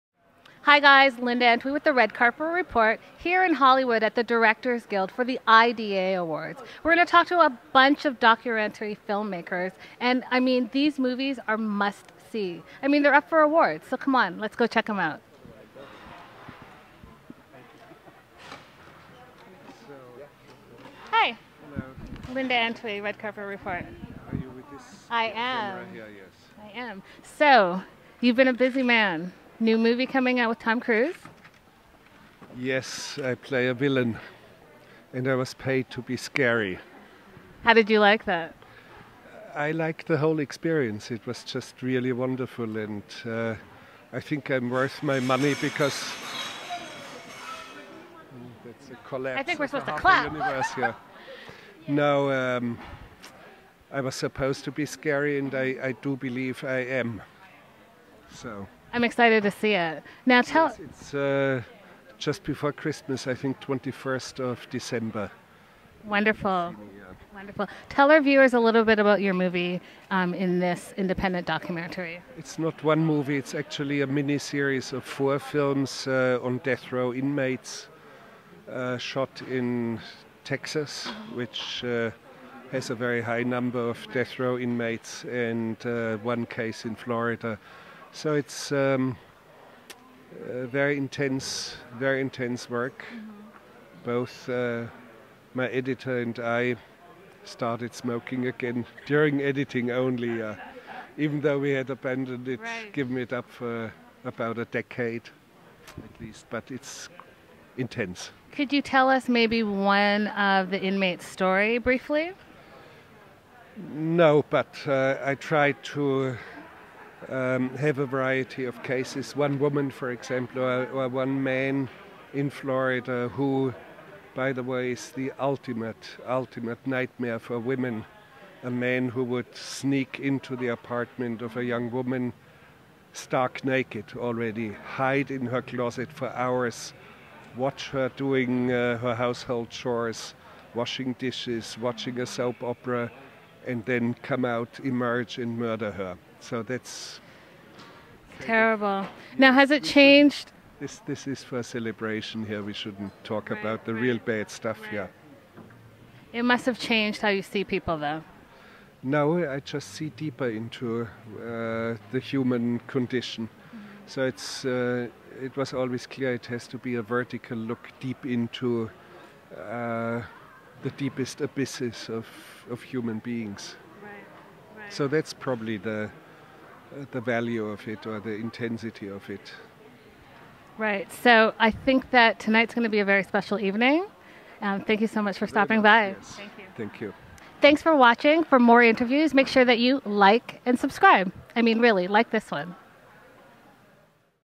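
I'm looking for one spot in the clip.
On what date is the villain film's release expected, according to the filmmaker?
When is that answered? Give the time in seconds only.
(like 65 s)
63 s.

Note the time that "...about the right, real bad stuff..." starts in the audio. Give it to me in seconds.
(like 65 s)
153 s.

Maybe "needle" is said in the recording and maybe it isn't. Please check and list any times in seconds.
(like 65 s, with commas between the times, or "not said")
not said.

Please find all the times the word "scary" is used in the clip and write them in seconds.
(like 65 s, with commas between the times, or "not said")
36 s, 54 s.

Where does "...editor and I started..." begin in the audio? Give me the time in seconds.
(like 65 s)
95 s.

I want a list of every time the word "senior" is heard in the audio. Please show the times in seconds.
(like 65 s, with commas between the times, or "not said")
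not said.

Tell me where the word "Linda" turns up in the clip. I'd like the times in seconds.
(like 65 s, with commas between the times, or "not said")
1 s, 22 s.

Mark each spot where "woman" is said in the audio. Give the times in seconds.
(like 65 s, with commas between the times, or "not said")
119 s, 131 s.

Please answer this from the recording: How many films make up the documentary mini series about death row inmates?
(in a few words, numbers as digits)
4.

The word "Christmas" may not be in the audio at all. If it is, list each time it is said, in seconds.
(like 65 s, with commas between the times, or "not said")
62 s.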